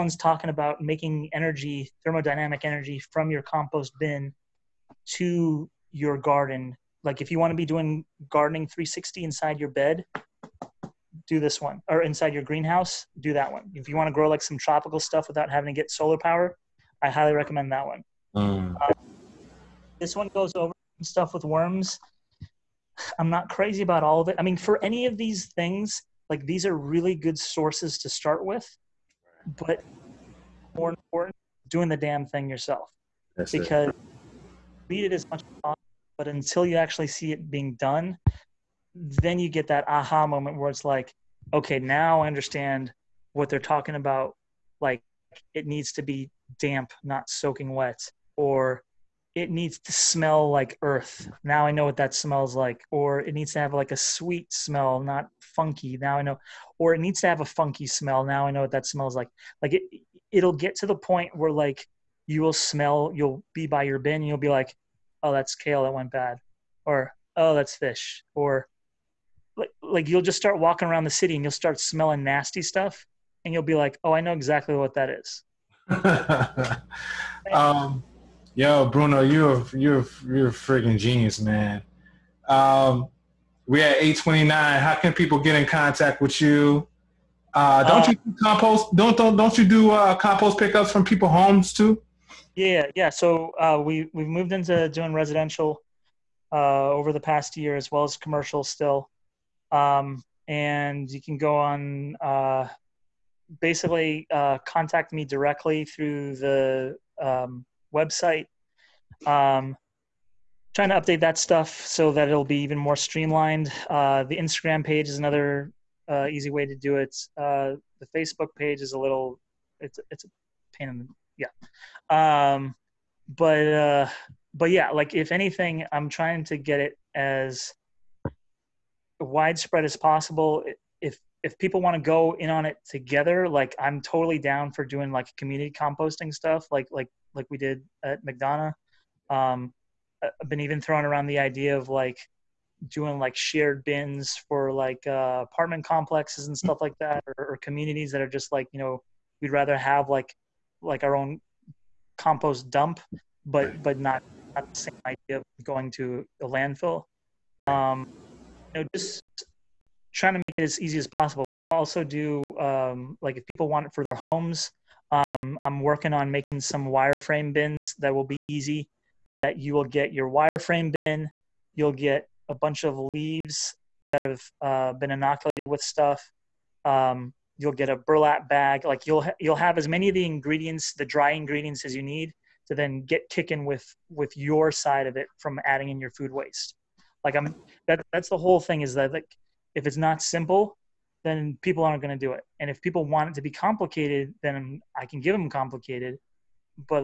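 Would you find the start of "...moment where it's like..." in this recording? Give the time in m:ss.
0:40.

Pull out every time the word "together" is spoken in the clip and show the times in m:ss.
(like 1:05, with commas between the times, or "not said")
2:12.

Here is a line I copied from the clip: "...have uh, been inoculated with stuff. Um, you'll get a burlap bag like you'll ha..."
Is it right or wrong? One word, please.
right.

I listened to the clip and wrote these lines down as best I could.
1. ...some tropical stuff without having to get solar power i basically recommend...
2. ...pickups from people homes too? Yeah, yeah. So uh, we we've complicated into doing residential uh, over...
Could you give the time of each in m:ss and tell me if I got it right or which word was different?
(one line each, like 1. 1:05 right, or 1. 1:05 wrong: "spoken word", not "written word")
1. 0:14 wrong: "highly", not "basically"
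2. 1:30 wrong: "moved", not "complicated".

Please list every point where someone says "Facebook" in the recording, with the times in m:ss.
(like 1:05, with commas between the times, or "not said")
1:58.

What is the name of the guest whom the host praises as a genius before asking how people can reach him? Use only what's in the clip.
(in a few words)
Bruno.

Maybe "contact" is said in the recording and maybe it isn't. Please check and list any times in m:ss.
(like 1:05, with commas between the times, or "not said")
1:25, 1:44.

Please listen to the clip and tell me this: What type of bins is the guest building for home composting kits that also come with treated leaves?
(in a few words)
wireframe bins.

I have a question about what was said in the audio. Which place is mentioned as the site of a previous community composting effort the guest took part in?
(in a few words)
McDonough.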